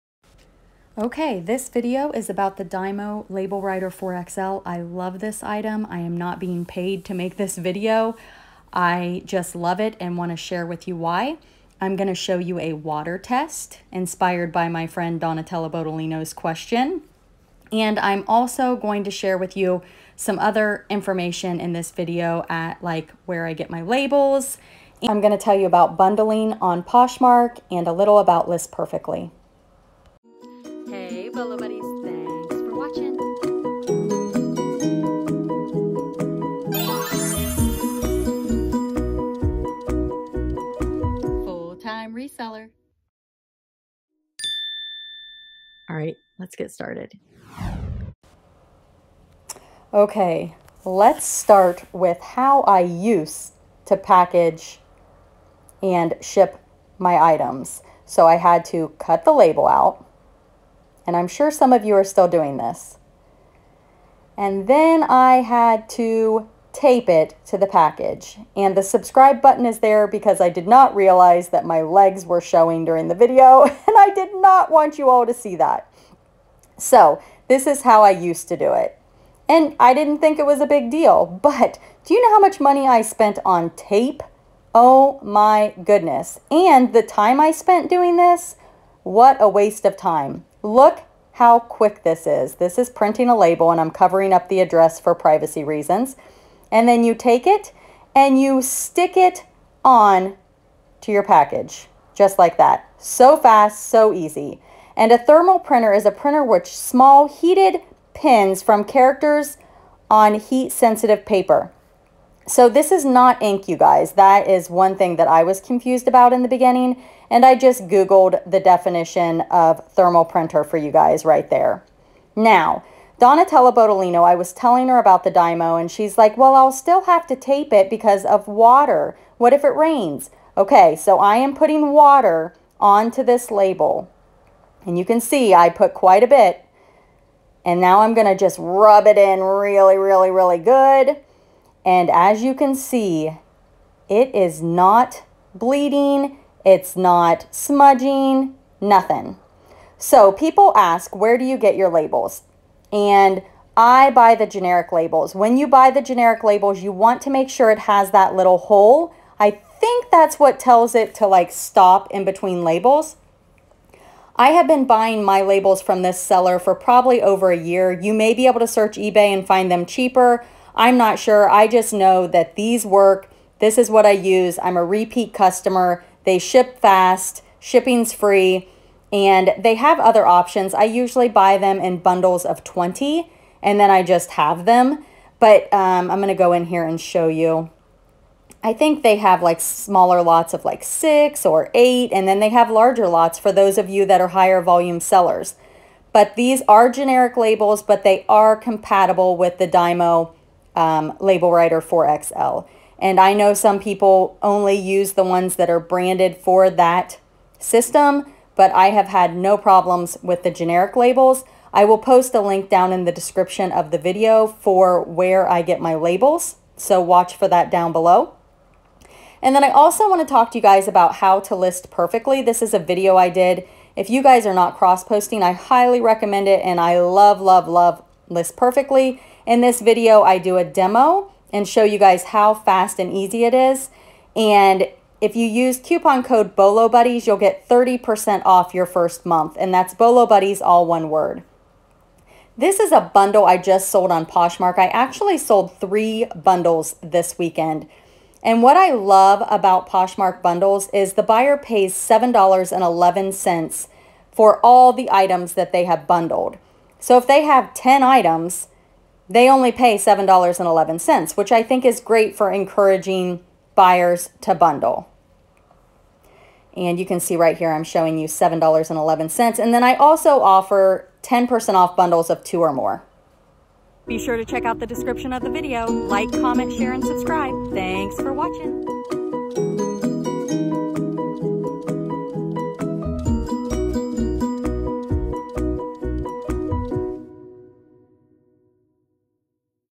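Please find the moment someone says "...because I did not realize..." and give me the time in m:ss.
1:10.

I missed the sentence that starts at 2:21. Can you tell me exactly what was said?
And as you can see, it is not bleeding, it's not smudging, nothing.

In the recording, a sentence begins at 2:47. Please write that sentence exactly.
You may be able to search eBay and find them cheaper, I'm not sure.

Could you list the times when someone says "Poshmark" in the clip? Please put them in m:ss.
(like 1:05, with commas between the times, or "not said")
0:26, 4:04, 4:09.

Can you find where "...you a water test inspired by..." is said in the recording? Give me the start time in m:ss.
0:12.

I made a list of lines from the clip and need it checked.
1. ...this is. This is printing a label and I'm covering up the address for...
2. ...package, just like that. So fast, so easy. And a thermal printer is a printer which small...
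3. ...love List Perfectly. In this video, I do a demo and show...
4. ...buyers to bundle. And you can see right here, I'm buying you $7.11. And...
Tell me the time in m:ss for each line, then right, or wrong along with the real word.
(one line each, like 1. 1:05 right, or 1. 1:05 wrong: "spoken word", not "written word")
1. 1:32 right
2. 1:41 right
3. 3:47 right
4. 4:23 wrong: "showing", not "buying".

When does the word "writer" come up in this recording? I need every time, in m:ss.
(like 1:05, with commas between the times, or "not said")
0:03, 3:21.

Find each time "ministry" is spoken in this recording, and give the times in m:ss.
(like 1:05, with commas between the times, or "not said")
not said.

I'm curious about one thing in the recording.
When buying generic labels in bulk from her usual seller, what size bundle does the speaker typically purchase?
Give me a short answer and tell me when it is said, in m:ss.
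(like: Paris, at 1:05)
20, at 3:01.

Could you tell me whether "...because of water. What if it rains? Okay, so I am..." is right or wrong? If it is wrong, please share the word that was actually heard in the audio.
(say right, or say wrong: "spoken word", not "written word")
right.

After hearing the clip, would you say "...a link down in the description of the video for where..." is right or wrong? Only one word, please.
right.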